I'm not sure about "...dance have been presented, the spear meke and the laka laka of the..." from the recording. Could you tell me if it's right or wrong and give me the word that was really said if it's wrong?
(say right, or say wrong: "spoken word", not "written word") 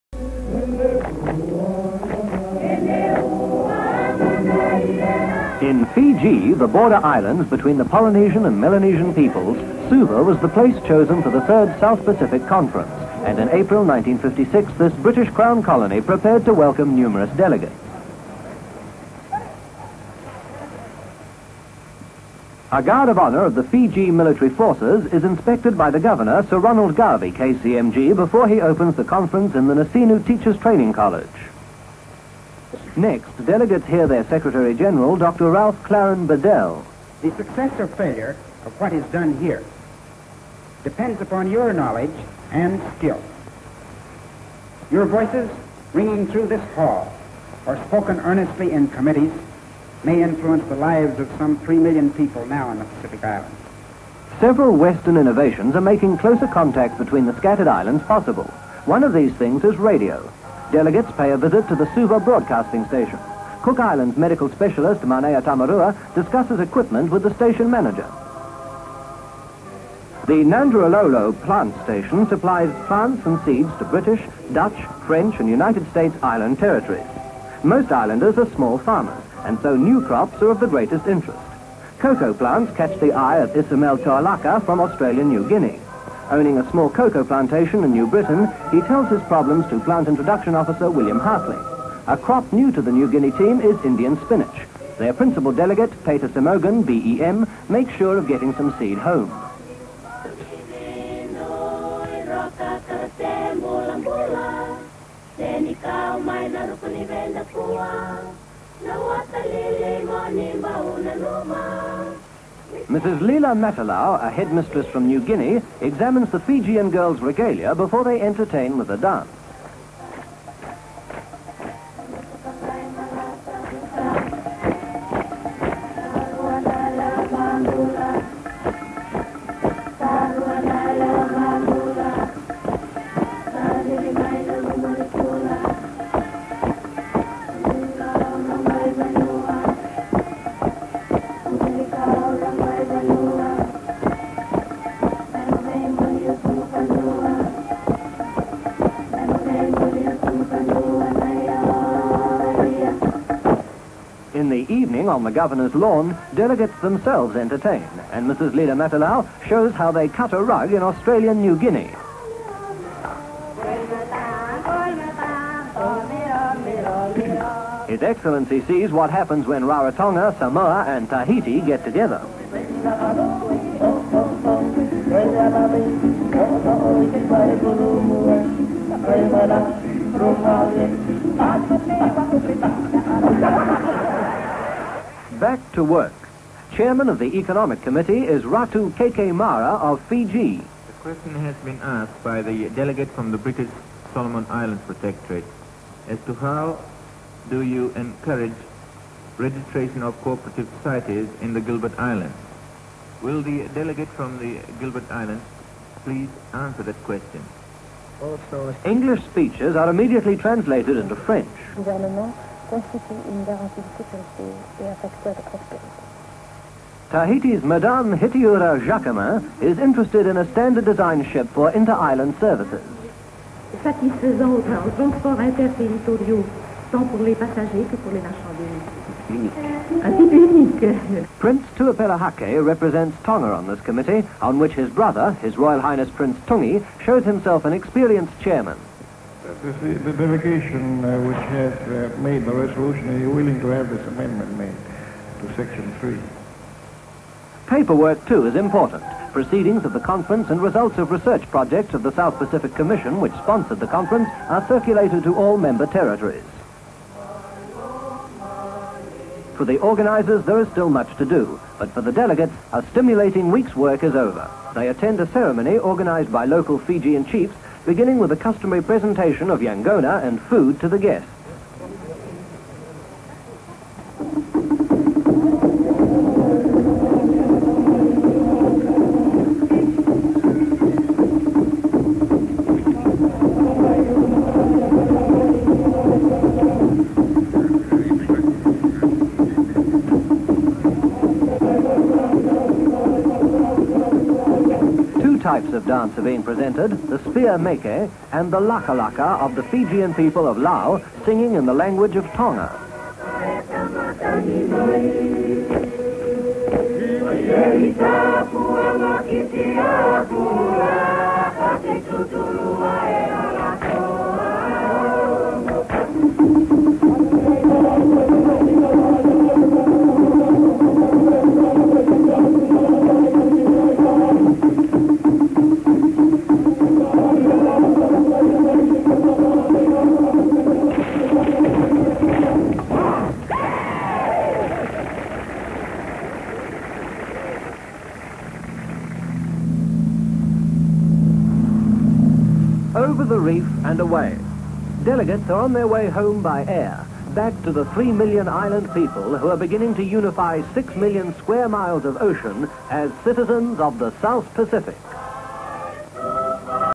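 right.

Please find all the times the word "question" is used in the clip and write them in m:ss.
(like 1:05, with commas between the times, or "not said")
3:11, 3:27.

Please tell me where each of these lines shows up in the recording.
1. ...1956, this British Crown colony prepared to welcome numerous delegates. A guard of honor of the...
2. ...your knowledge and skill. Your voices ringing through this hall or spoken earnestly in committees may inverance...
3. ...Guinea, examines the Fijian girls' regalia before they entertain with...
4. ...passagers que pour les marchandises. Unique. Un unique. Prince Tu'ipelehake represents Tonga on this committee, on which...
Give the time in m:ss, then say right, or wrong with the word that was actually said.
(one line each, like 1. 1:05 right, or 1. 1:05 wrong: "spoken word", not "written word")
1. 0:13 right
2. 0:41 wrong: "influence", not "inverance"
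3. 1:55 right
4. 3:47 right.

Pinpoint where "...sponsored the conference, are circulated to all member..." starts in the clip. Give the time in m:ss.
4:13.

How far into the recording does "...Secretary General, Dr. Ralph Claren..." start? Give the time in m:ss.
0:34.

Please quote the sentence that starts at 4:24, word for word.
They attend a ceremony organized by local Fijian chiefs beginning with a customary presentation of Yangona and food to the guests.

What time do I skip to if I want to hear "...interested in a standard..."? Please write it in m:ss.
3:39.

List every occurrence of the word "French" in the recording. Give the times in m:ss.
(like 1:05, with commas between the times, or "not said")
1:15, 3:31.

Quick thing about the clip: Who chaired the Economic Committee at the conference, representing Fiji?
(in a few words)
Ratu Keke Mara.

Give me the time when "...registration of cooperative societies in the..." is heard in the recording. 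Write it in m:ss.
3:19.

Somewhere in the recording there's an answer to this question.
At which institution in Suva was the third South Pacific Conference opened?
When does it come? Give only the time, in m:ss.
0:29.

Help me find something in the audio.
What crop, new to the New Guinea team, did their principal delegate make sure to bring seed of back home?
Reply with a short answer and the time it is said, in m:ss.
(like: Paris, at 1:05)
Indian spinach, at 1:33.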